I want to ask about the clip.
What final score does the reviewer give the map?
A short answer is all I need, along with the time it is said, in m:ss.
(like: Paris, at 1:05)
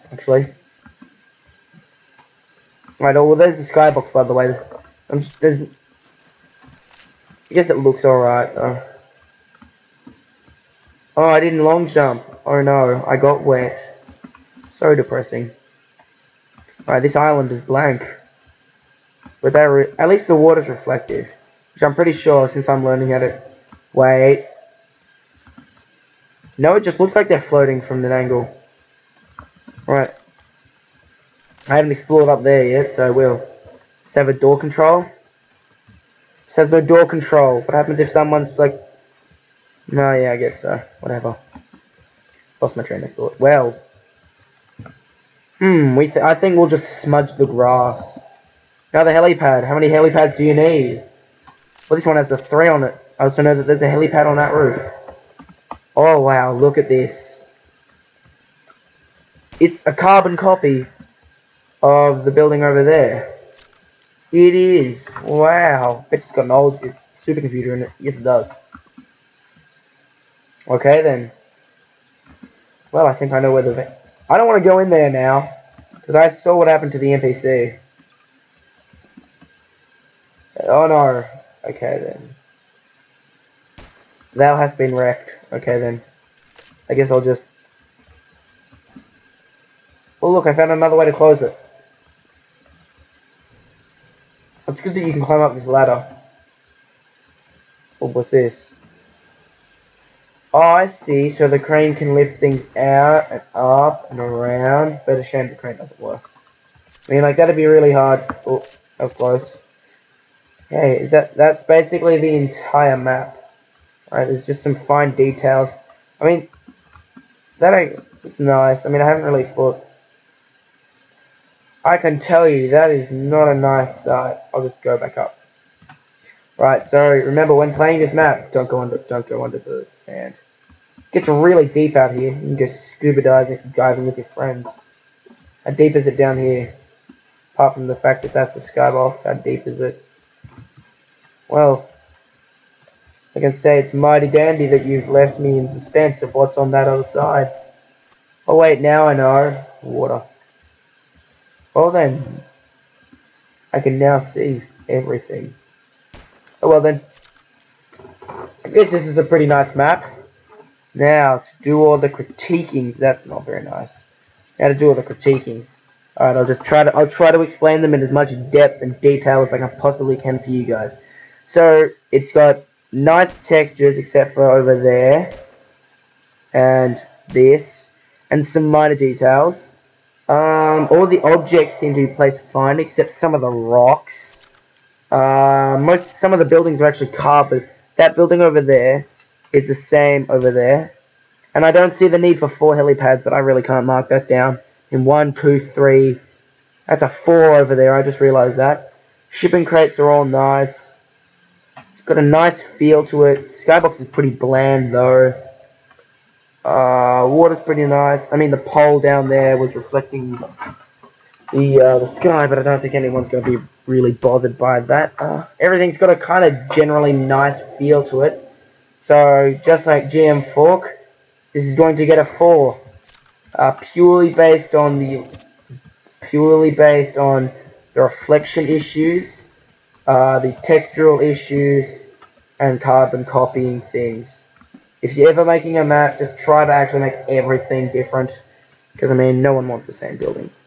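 4, at 3:42.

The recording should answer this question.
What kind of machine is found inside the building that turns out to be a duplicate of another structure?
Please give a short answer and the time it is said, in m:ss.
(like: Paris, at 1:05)
supercomputer, at 1:07.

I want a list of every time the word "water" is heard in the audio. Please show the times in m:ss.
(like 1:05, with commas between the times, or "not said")
0:20, 2:29, 3:27.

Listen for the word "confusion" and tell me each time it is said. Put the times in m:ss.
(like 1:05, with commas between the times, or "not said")
not said.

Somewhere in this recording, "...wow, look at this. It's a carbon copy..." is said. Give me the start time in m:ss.
0:56.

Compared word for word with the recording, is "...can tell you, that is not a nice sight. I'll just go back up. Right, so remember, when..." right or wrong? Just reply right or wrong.
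right.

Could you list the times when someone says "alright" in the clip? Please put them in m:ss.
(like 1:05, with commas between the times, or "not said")
0:08, 0:16, 1:54, 2:46.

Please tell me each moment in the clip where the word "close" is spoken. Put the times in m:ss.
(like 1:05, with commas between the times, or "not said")
1:31, 1:49.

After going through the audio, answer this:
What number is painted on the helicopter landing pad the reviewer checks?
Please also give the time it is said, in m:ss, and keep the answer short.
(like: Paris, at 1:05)
3, at 0:52.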